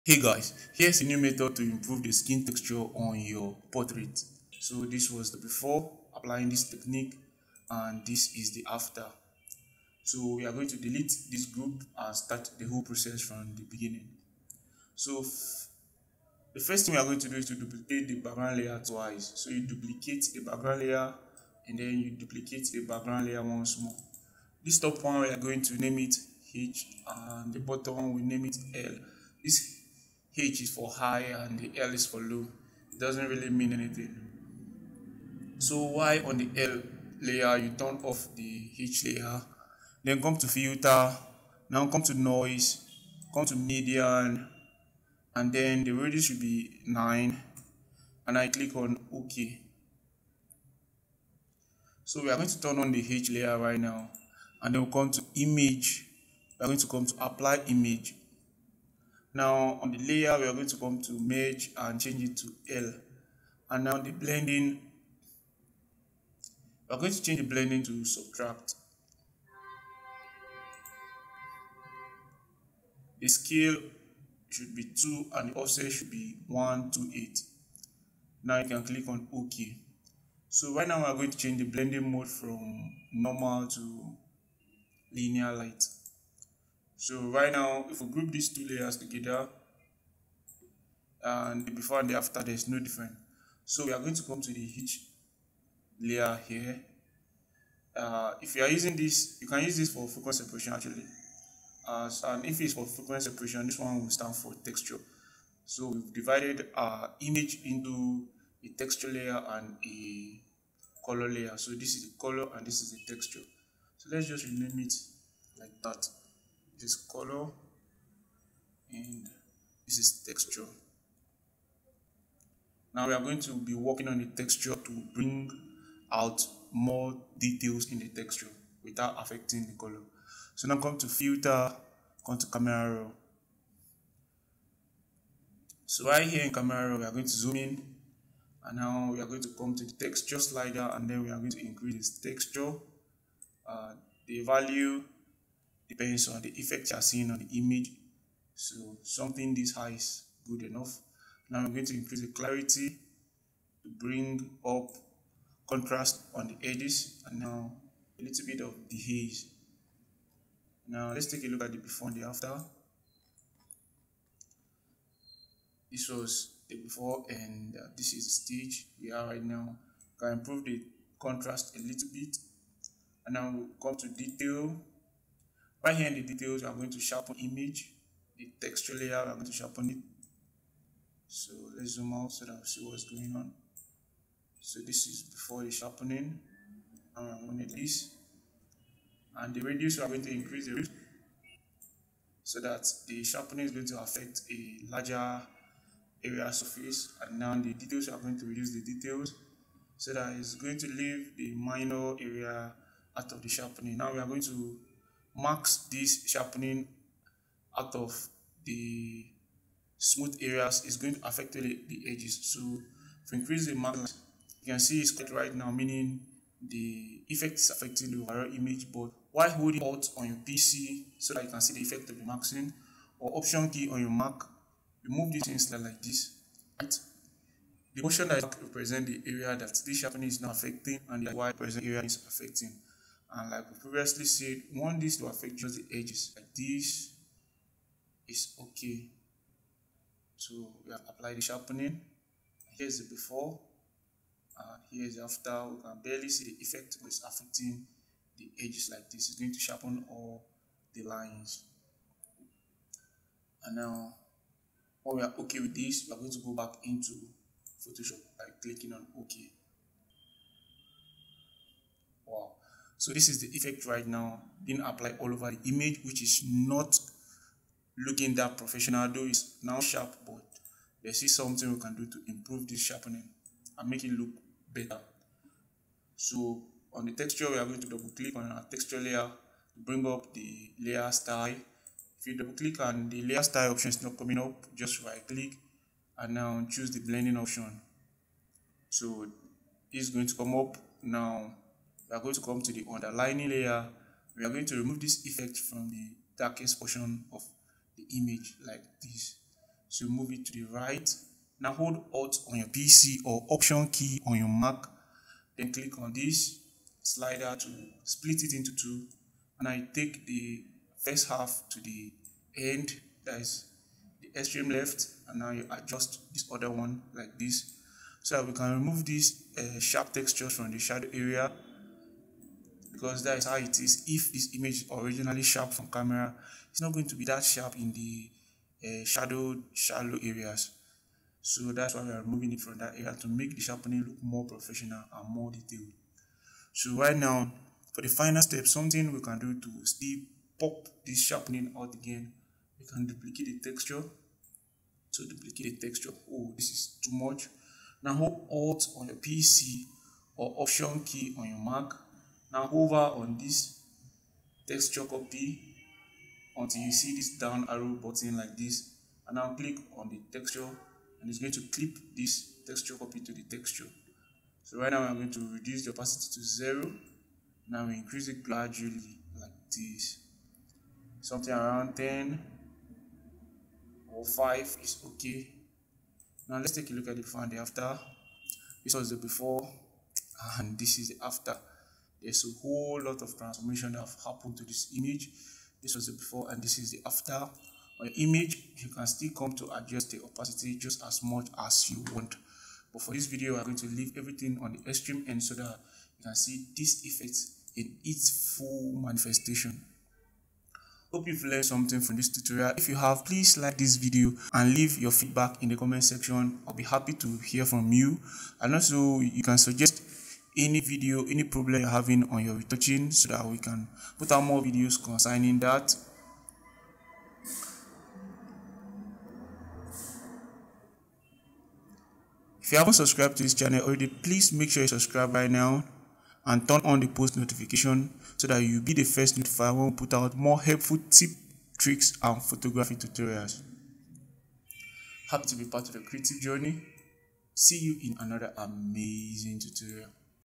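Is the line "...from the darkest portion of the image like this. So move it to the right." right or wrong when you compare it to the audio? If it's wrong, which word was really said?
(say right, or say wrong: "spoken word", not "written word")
right.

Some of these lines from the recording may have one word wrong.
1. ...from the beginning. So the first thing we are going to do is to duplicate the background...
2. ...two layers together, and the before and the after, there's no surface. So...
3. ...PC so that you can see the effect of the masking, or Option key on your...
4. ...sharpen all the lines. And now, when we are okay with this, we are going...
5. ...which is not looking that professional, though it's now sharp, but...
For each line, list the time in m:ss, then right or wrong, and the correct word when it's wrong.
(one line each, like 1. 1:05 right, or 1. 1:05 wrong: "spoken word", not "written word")
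1. 0:13 right
2. 1:28 wrong: "difference", not "surface"
3. 3:40 right
4. 4:09 right
5. 4:26 right.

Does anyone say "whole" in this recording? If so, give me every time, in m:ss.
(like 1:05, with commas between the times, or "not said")
0:12, 6:22.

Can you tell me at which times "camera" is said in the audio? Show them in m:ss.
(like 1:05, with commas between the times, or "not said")
2:12, 2:16, 5:25.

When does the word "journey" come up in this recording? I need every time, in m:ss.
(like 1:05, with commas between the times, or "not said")
7:16.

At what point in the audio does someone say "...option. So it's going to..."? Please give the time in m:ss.
4:47.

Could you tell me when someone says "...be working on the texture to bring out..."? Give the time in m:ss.
2:03.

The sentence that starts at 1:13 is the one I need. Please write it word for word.
The scale should be 2 and the offset should be one to eight.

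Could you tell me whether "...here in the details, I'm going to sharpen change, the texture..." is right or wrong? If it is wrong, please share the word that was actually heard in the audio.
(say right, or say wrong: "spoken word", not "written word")
wrong: "image", not "change".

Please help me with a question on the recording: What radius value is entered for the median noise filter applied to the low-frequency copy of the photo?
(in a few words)
9.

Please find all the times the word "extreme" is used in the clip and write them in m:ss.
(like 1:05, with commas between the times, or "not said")
5:14, 6:34.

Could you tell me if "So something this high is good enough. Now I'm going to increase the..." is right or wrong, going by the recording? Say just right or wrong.
right.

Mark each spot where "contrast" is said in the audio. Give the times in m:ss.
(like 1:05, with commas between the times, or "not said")
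2:35, 2:51.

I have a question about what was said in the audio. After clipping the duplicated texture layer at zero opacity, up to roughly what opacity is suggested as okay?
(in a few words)
10.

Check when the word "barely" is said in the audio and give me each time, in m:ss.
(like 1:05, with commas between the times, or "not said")
4:06.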